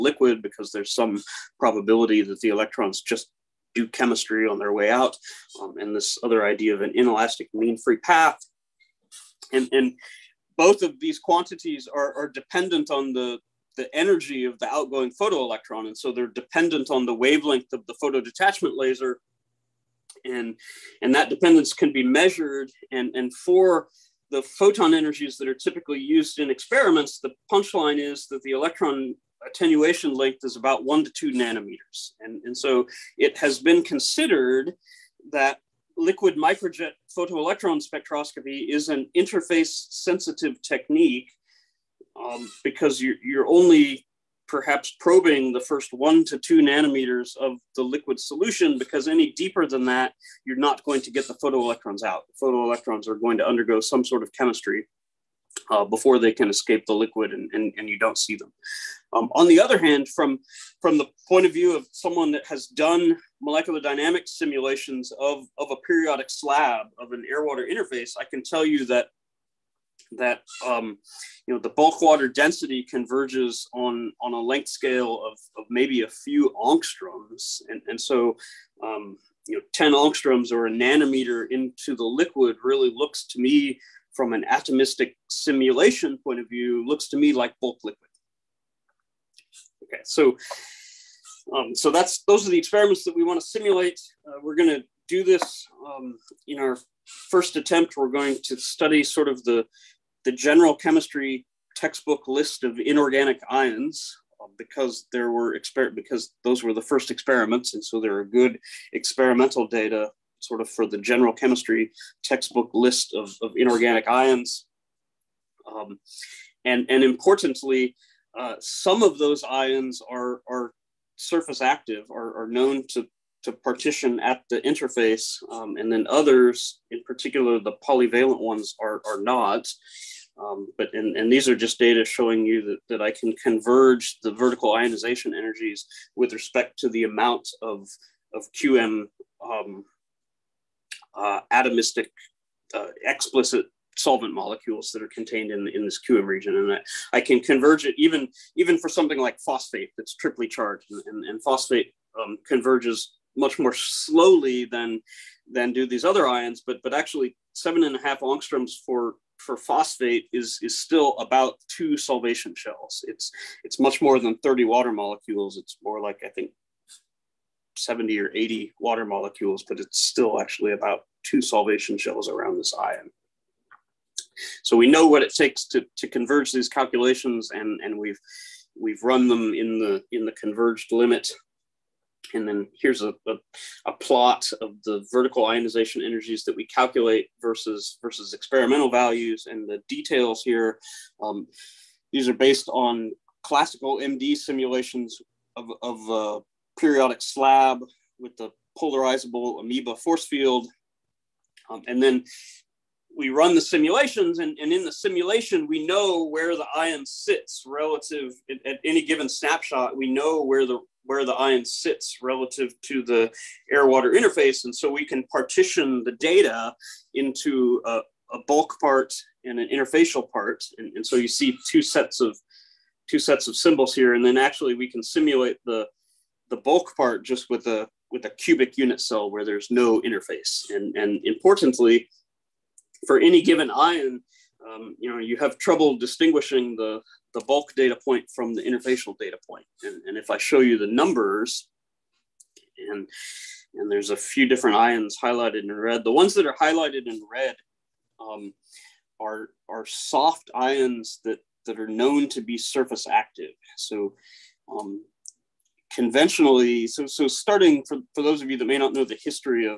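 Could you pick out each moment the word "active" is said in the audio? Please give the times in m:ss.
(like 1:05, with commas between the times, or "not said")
2:01, 4:13.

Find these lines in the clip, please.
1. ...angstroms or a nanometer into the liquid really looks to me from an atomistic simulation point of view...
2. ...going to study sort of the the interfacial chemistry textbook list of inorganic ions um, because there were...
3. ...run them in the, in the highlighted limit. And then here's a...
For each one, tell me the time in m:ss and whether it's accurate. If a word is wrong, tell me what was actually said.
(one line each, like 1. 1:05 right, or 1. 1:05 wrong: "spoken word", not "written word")
1. 1:19 right
2. 1:38 wrong: "general", not "interfacial"
3. 2:59 wrong: "converged", not "highlighted".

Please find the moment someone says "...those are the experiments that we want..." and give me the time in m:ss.
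1:32.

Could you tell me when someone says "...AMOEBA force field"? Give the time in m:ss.
3:19.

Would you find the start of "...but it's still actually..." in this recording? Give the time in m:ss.
2:49.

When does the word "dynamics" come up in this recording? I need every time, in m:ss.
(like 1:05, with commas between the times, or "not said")
1:03.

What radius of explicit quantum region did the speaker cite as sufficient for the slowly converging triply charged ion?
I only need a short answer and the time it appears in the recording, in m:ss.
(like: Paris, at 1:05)
7.5 angstroms, at 2:37.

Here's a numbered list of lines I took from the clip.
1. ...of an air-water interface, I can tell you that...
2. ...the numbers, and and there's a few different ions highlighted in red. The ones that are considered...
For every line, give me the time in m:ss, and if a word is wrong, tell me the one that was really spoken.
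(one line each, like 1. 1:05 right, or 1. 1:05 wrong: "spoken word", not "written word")
1. 1:06 right
2. 4:00 wrong: "highlighted", not "considered".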